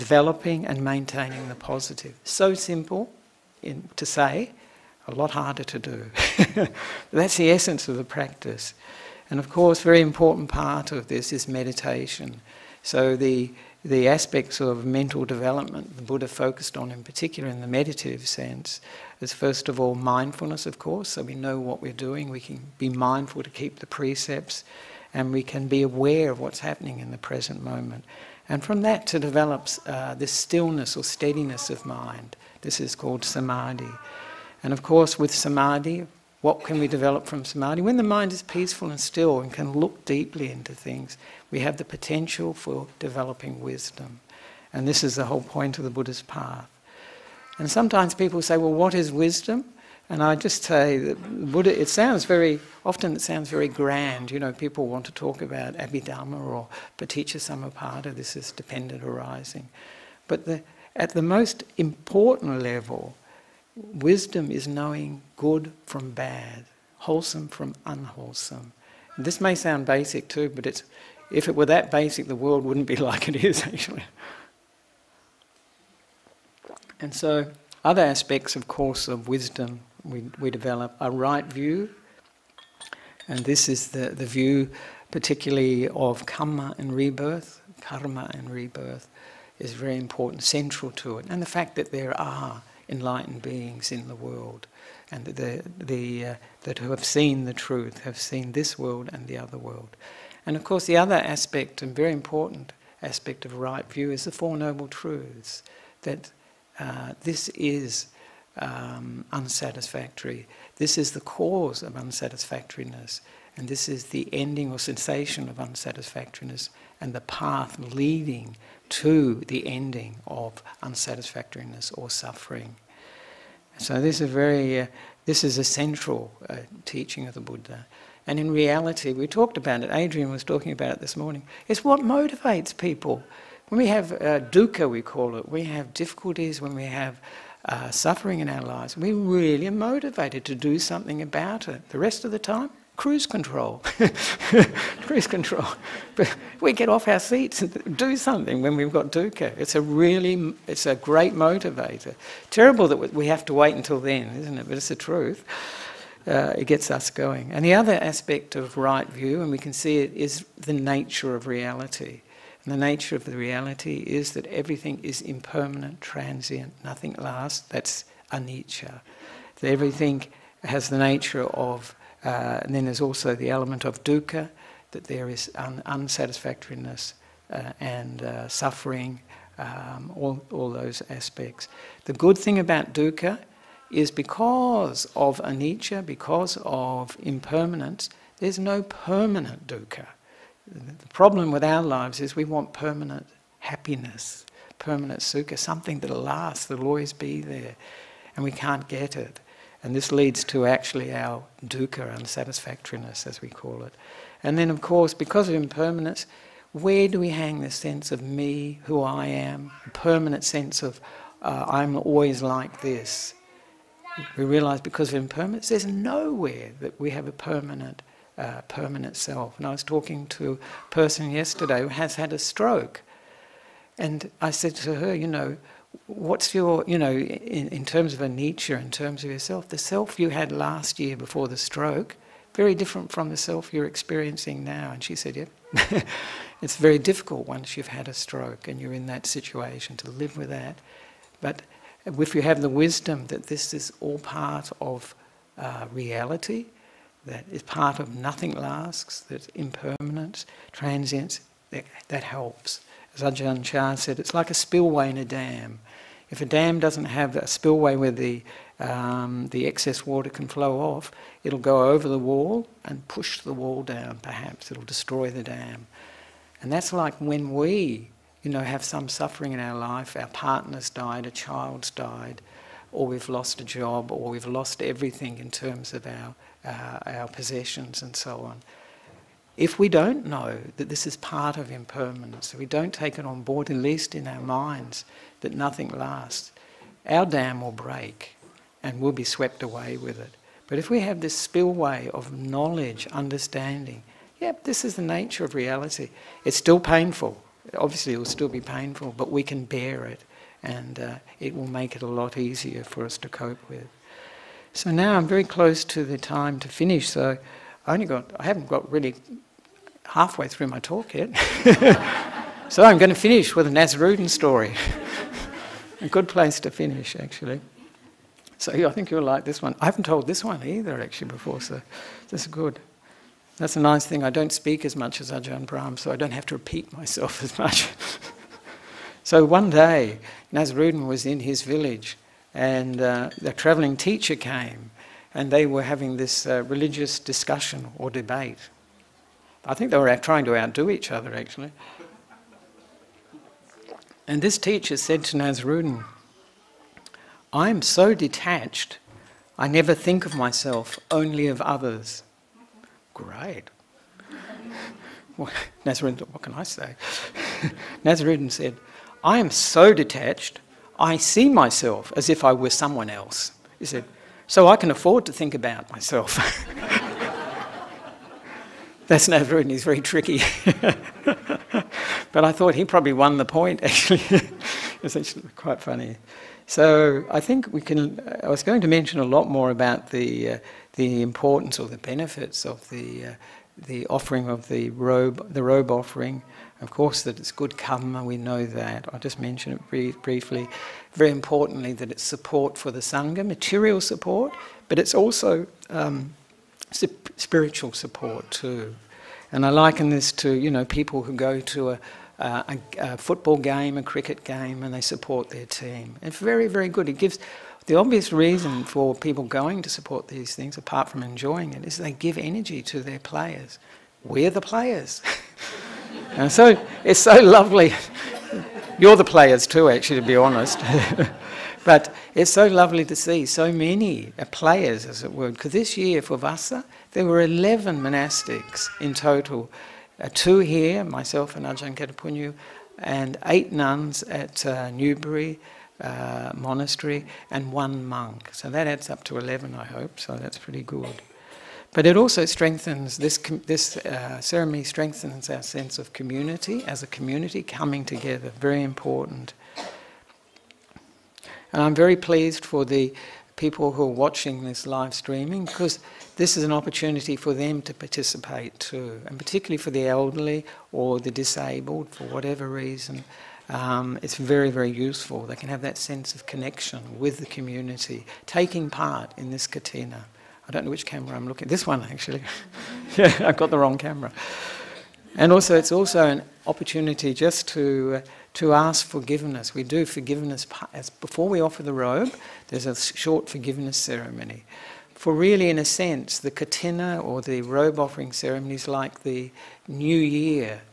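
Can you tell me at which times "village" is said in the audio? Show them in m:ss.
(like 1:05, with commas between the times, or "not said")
5:31.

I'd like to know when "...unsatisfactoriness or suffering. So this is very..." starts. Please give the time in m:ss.
2:00.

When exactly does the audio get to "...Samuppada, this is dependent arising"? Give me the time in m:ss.
0:57.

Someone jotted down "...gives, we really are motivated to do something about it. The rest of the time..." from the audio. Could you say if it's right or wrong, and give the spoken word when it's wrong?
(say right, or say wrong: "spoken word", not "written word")
wrong: "lives", not "gives".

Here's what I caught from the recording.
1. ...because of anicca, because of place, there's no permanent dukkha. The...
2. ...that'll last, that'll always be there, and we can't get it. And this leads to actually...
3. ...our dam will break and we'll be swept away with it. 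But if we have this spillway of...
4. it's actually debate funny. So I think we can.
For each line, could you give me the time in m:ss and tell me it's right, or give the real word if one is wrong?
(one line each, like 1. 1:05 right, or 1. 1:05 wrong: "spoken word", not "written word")
1. 3:04 wrong: "impermanence", not "place"
2. 3:15 right
3. 4:47 right
4. 6:15 wrong: "quite", not "debate".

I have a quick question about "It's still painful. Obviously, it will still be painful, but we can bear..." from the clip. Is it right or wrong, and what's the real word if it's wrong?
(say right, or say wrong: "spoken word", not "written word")
right.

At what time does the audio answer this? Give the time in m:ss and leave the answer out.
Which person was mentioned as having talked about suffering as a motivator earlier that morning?
2:09.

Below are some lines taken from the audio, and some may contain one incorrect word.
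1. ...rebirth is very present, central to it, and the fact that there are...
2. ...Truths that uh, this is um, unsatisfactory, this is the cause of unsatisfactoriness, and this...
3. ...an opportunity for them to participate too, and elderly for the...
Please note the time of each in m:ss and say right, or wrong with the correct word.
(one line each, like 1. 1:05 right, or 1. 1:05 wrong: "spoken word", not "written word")
1. 1:28 wrong: "important", not "present"
2. 1:44 right
3. 7:36 wrong: "particularly", not "elderly".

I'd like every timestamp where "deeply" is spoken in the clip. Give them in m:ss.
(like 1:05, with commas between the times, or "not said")
0:40.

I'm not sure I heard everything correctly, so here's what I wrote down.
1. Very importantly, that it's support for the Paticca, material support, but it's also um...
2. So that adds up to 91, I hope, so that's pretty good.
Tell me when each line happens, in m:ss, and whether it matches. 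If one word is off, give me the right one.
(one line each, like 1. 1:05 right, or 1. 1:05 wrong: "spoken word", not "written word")
1. 6:31 wrong: "Sangha", not "Paticca"
2. 7:18 wrong: "11", not "91".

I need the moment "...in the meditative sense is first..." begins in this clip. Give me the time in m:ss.
0:17.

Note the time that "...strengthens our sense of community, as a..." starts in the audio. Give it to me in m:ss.
7:24.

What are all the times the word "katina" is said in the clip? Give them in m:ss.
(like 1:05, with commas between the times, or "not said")
7:49, 8:06.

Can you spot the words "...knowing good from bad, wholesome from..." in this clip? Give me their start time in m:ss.
1:04.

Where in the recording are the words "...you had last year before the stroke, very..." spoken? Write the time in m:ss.
3:50.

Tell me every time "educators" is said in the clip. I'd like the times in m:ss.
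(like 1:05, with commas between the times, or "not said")
not said.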